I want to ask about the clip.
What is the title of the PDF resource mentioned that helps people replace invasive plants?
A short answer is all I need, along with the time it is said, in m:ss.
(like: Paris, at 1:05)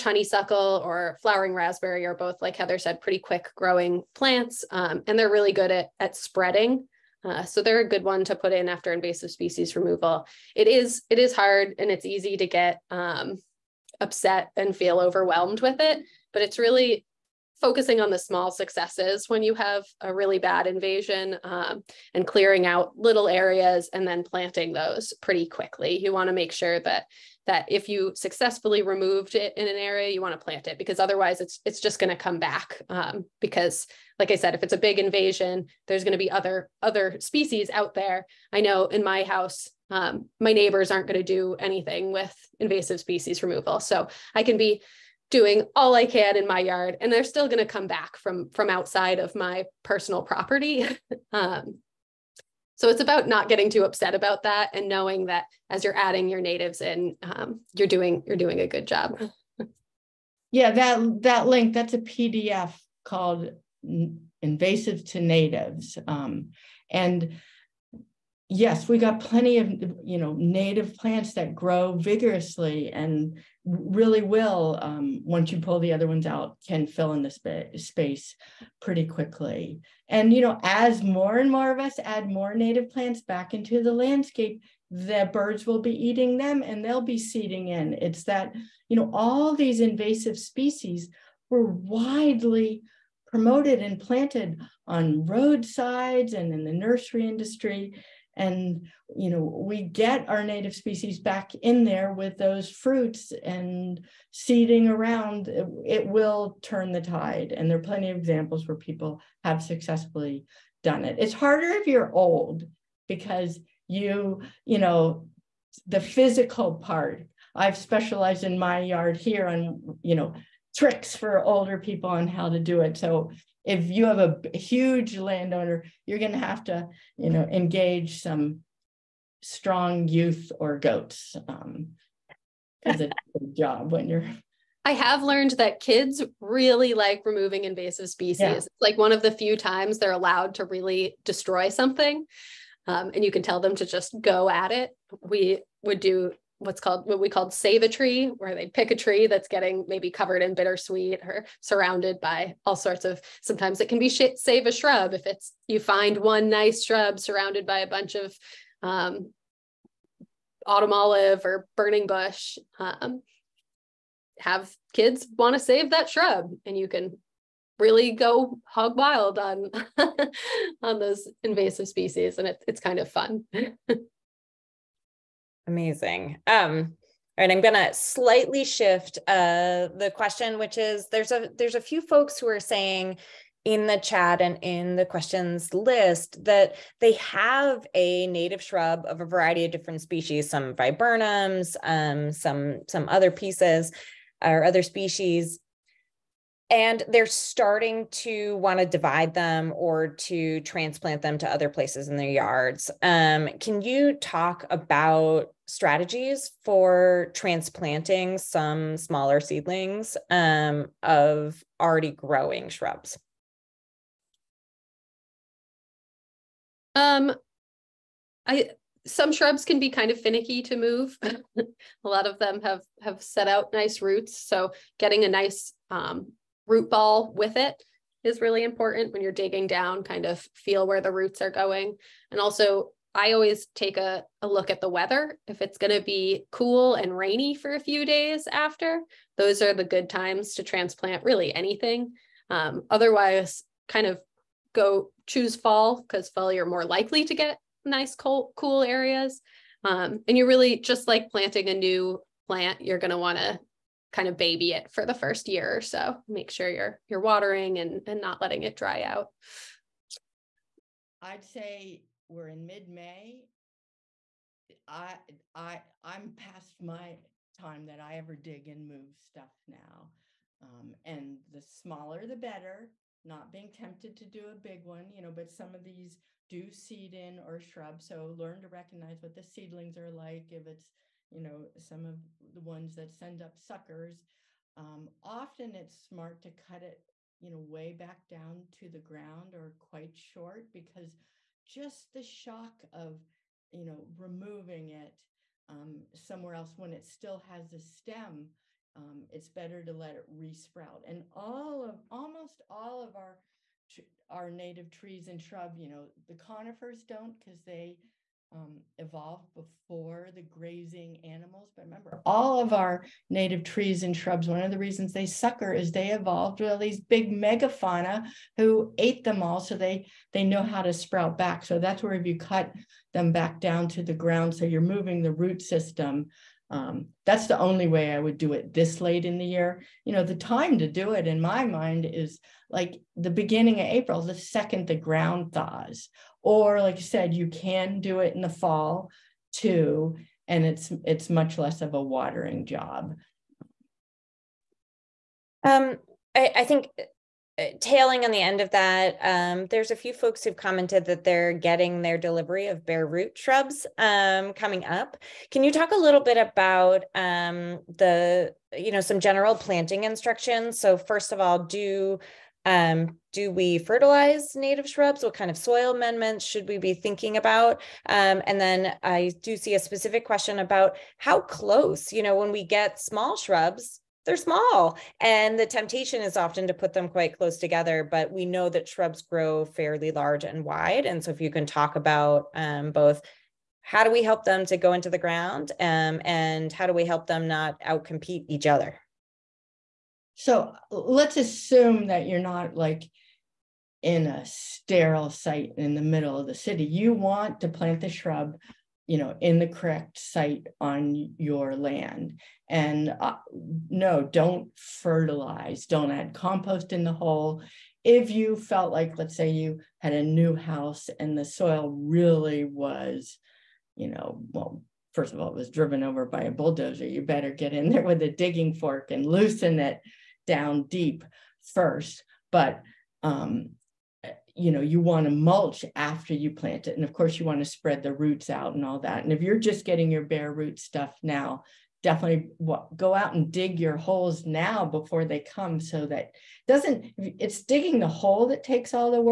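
Invasive to Natives, at 1:04.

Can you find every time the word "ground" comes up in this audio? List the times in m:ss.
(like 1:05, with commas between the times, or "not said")
4:48, 5:24, 5:34, 6:25.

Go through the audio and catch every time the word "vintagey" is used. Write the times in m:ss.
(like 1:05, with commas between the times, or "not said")
not said.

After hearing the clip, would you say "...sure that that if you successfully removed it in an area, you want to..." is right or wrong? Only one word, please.
right.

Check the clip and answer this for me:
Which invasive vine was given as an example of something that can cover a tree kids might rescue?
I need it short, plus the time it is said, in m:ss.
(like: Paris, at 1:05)
Bittersweet, at 2:30.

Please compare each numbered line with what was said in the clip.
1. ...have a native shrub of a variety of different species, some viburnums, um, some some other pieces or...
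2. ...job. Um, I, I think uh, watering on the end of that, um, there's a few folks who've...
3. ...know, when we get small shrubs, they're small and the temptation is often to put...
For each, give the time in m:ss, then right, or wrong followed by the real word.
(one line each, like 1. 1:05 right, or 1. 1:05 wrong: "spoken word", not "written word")
1. 3:07 right
2. 5:42 wrong: "tailing", not "watering"
3. 6:12 right.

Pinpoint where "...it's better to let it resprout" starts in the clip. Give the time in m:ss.
4:59.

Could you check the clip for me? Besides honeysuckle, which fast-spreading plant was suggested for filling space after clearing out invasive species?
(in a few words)
Flowering raspberry.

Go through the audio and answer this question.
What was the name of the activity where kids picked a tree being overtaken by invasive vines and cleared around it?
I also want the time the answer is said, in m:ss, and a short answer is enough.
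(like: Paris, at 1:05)
Save a tree, at 2:27.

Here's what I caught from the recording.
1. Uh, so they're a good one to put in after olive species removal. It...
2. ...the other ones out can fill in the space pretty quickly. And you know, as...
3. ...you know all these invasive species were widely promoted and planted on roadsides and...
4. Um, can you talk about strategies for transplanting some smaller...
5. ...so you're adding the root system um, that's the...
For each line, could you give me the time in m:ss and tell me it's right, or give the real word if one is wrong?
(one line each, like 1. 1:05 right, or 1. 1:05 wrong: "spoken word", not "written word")
1. 0:07 wrong: "invasive", not "olive"
2. 1:15 right
3. 1:28 right
4. 3:23 right
5. 5:24 wrong: "moving", not "adding".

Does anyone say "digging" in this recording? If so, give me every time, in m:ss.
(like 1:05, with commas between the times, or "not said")
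3:49, 6:58, 7:17.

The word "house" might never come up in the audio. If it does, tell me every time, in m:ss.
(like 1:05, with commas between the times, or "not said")
0:39, 6:50.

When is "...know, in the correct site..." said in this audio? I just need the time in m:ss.
6:39.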